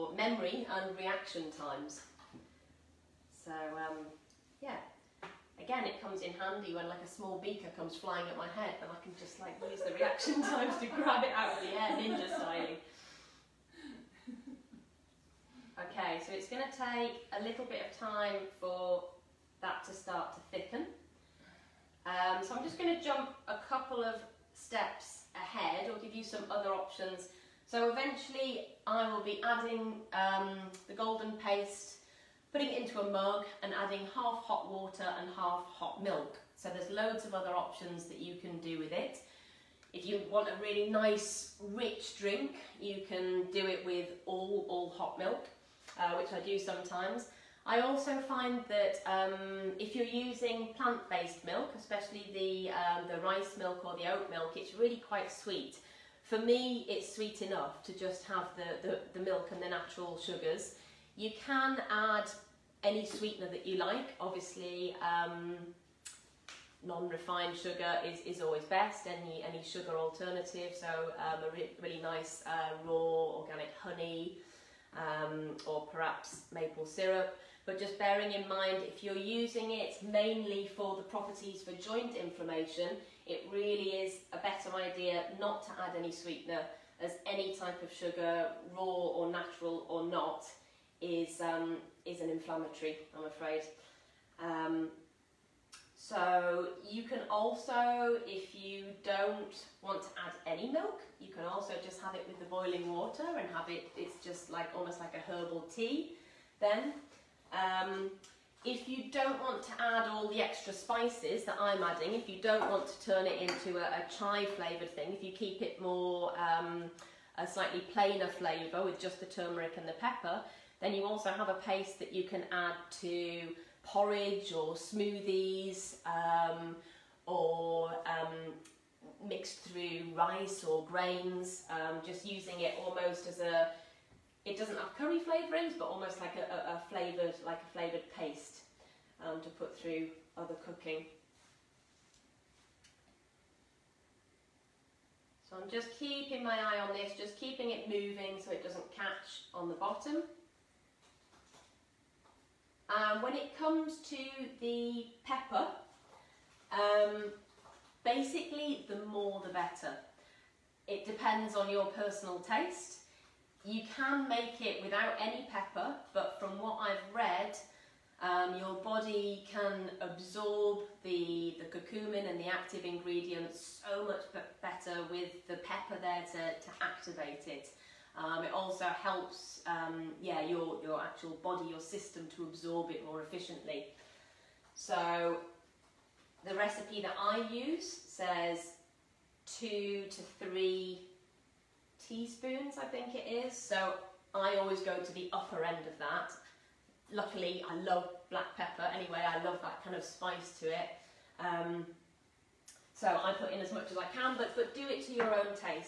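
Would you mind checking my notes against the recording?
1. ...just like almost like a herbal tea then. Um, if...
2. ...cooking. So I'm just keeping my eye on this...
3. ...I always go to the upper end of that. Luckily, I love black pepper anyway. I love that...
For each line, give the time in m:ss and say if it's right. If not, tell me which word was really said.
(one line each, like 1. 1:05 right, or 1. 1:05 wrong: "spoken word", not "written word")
1. 1:44 right
2. 2:20 right
3. 3:14 right.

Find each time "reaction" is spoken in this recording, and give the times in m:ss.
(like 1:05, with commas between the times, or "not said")
0:00, 0:09.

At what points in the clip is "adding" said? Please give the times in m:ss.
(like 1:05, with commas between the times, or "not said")
0:29, 0:33, 1:51.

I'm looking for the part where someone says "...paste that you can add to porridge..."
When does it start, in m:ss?
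2:01.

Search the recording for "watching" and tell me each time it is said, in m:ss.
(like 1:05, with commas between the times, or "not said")
not said.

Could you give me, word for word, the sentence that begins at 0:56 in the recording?
For me, it's sweet enough to just have the, the, the milk and the natural sugars.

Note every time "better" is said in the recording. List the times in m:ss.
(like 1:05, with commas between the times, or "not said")
1:24, 2:39, 2:54.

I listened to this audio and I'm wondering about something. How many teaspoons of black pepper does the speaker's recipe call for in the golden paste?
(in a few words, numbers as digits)
2 to 3 teaspoons.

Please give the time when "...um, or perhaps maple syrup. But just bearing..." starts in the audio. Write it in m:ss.
1:14.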